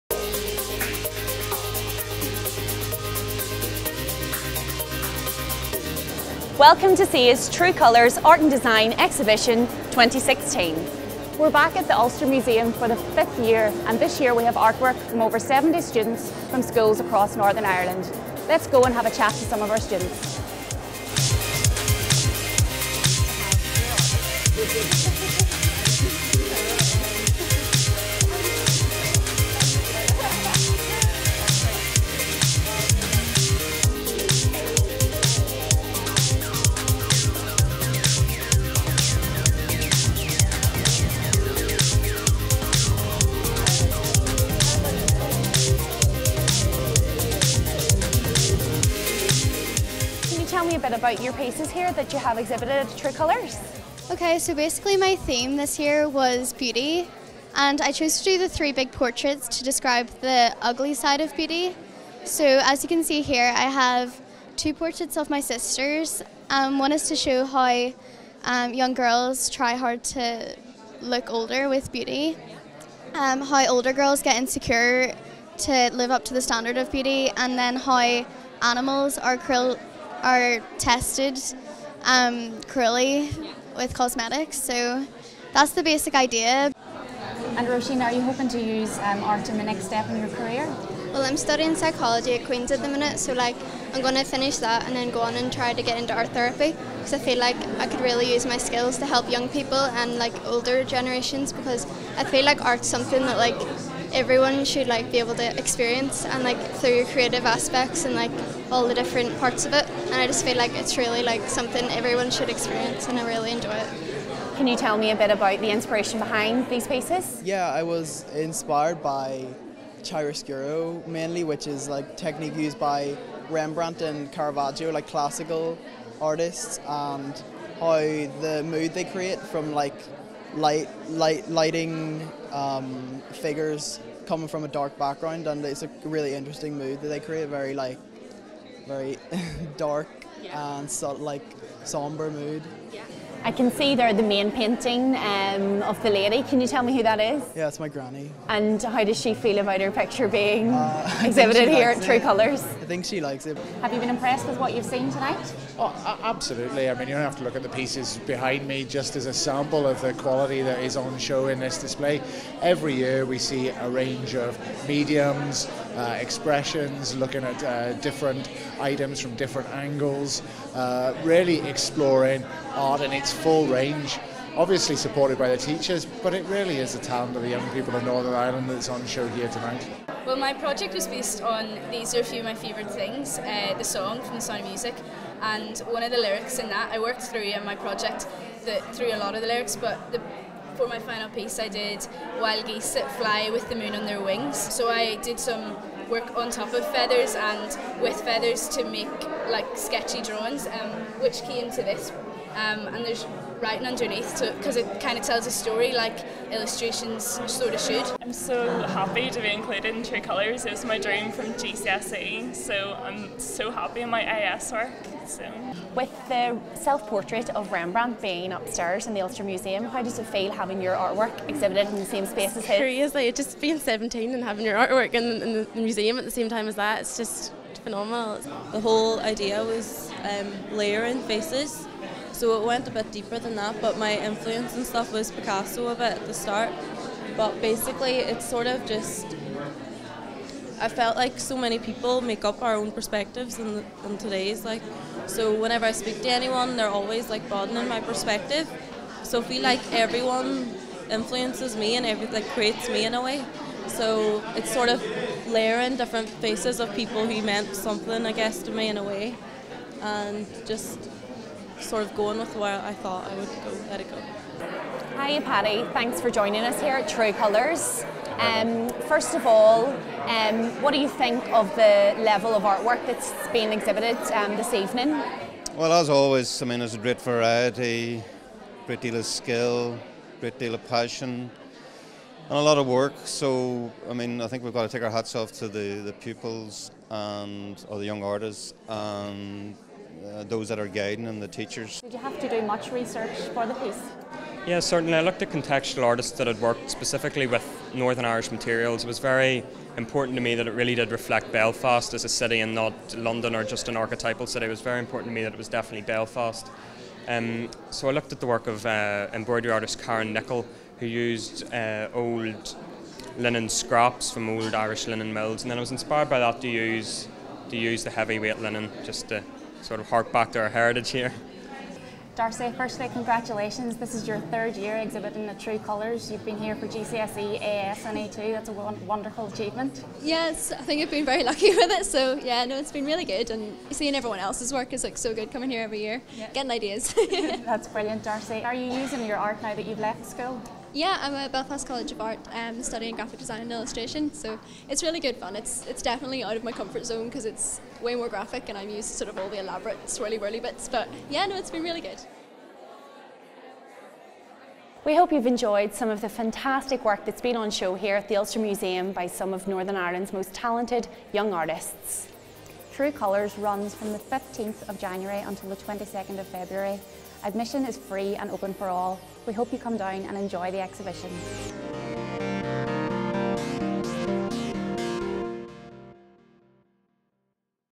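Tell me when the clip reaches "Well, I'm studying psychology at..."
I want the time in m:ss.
1:31.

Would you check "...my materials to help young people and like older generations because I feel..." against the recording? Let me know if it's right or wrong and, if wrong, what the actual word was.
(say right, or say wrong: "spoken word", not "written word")
wrong: "skills", not "materials".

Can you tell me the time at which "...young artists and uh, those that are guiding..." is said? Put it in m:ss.
4:48.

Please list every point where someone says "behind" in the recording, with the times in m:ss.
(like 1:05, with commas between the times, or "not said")
1:56, 2:38.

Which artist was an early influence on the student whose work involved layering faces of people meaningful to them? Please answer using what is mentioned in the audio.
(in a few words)
Picasso.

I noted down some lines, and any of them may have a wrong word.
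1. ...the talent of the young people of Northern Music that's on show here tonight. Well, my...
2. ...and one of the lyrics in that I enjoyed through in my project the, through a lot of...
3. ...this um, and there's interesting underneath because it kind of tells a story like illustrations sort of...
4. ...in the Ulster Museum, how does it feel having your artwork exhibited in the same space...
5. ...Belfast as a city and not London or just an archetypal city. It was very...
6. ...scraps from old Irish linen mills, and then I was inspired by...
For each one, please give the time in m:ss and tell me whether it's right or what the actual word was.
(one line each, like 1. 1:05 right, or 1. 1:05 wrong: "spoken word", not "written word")
1. 2:56 wrong: "Ireland", not "Music"
2. 3:05 wrong: "worked", not "enjoyed"
3. 3:21 wrong: "writing", not "interesting"
4. 3:39 right
5. 5:01 right
6. 5:13 right.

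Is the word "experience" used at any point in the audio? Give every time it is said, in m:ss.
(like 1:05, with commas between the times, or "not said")
1:45, 1:52.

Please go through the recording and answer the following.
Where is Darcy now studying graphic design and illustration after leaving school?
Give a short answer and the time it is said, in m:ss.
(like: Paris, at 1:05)
Belfast College of Art, at 5:41.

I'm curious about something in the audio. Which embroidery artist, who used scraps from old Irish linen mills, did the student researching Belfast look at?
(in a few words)
Karen Nicol.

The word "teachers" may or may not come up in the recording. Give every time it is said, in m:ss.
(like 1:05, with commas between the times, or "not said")
2:55, 4:51.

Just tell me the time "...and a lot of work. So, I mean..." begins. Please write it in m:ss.
4:42.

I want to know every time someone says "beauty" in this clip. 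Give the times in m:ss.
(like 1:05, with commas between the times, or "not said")
0:56, 1:01, 1:11, 1:16.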